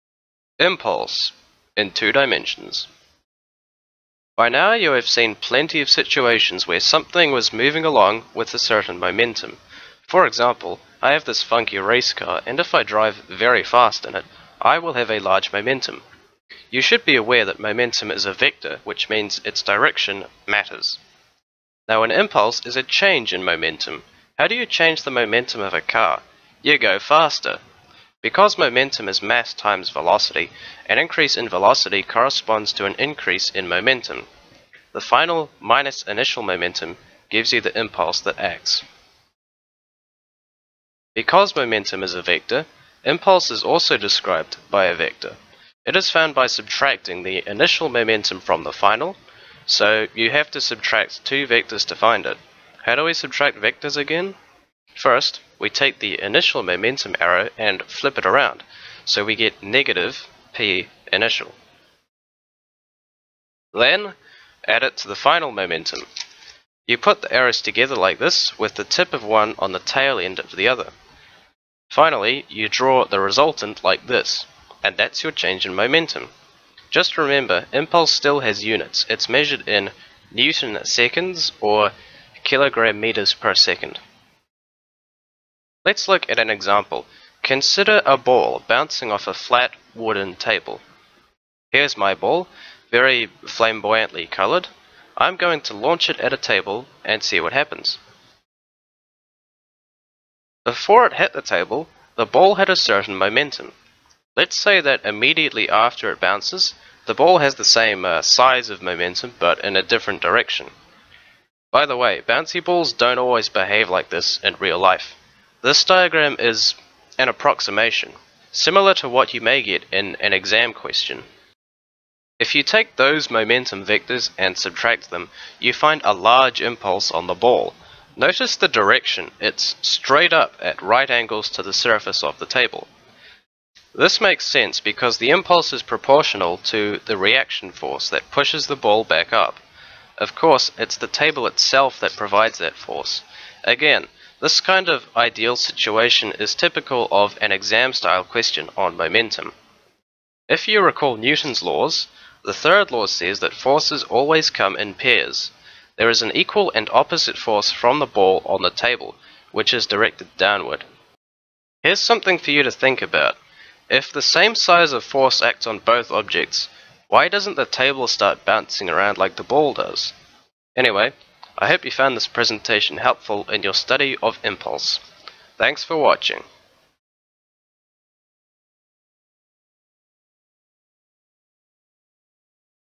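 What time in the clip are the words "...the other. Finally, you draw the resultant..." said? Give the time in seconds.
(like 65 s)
70 s.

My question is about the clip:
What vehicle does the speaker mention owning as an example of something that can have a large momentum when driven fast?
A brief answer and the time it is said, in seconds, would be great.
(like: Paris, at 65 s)
race car, at 11 s.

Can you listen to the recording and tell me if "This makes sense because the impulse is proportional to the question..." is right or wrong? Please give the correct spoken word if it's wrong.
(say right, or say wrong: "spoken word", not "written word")
wrong: "reaction", not "question".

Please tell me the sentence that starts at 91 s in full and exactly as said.
Here's my ball, very flamboyantly colored.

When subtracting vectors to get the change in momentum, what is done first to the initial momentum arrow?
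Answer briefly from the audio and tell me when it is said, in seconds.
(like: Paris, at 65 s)
flip it around, at 57 s.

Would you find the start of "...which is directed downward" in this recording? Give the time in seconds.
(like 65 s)
159 s.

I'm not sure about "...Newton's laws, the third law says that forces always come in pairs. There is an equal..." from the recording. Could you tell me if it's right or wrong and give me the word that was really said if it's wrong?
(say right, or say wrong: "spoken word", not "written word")
right.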